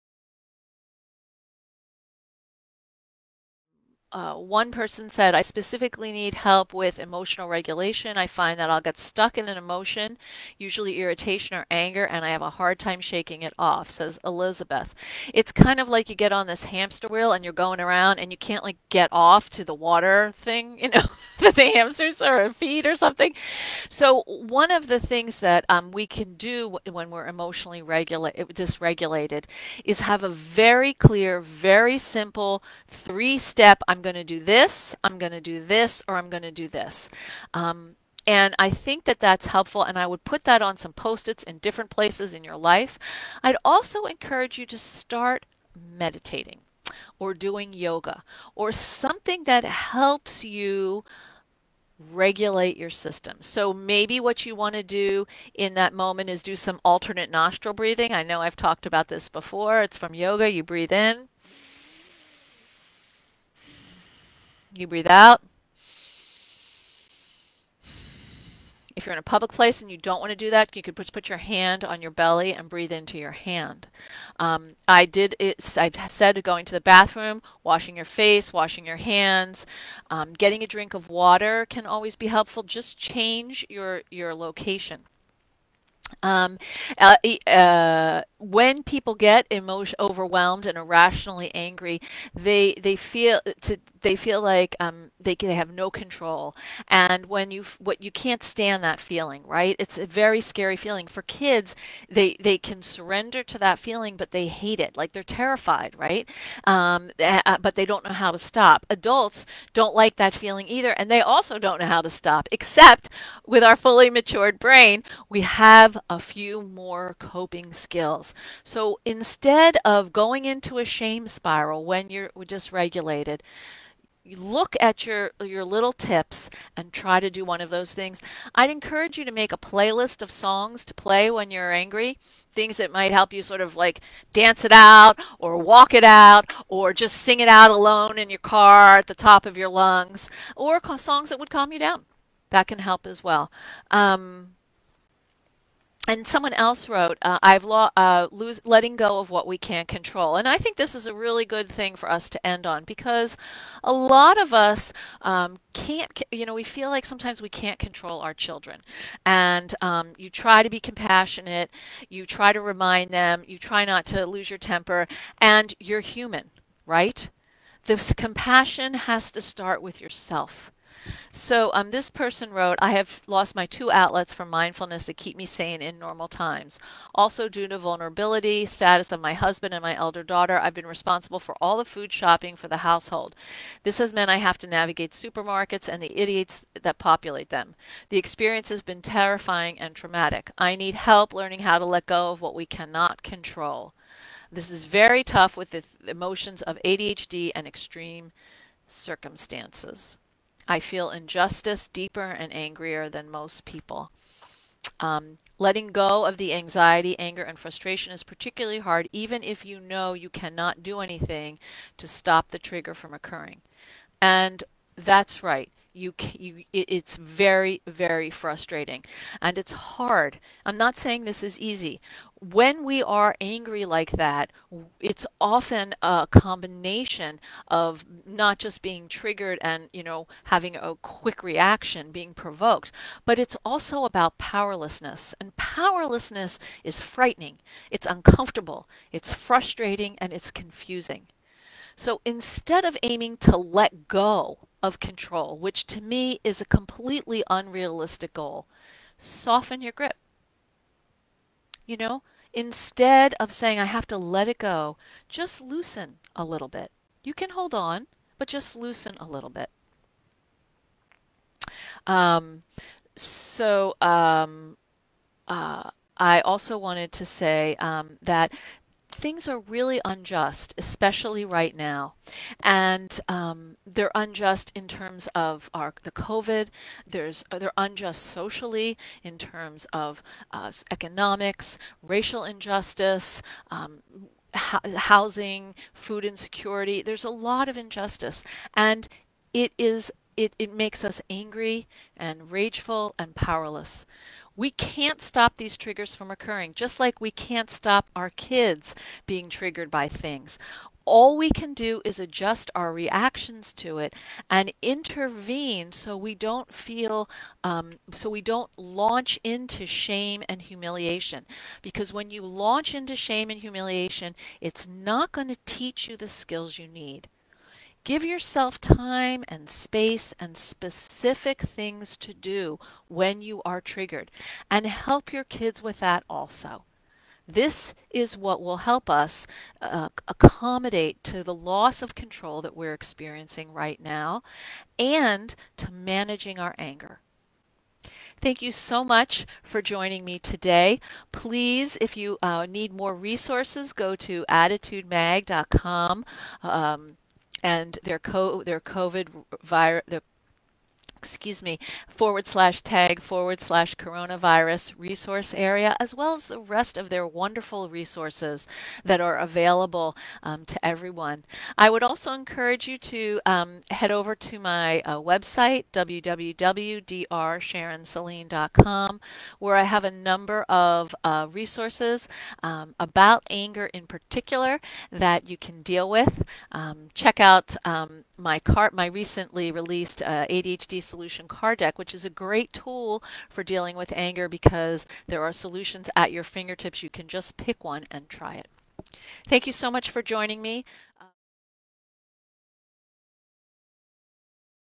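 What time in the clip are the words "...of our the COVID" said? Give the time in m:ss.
4:35.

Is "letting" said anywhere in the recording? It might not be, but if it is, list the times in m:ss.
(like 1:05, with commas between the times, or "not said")
2:28, 3:25.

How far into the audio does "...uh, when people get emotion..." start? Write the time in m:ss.
1:27.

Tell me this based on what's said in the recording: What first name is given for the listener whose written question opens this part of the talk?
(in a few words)
Elizabeth.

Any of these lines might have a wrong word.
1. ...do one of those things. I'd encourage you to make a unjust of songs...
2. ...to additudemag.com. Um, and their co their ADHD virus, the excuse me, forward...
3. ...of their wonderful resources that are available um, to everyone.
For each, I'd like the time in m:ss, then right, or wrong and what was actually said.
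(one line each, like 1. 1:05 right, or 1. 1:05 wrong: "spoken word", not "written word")
1. 2:07 wrong: "playlist", not "unjust"
2. 5:44 wrong: "COVID", not "ADHD"
3. 5:56 right.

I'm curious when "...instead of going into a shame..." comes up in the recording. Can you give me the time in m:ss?
1:59.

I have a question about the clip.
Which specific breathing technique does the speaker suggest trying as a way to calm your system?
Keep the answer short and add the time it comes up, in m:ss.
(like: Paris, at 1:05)
Alternate nostril breathing, at 0:56.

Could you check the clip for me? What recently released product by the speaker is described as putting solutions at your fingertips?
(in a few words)
ADHD solution card deck.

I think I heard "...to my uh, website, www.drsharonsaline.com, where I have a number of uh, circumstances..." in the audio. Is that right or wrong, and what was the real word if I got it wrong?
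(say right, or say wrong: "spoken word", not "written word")
wrong: "resources", not "circumstances".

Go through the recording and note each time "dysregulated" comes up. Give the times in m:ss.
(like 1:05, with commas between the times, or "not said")
0:28, 2:02.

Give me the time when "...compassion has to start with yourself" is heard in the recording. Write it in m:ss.
2:48.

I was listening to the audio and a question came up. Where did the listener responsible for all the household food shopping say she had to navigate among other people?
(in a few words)
Supermarkets.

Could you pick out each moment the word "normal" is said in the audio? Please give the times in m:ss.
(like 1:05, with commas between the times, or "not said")
2:55.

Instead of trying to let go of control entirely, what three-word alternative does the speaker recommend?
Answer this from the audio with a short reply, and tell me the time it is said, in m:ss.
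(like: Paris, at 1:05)
Soften your grip, at 4:09.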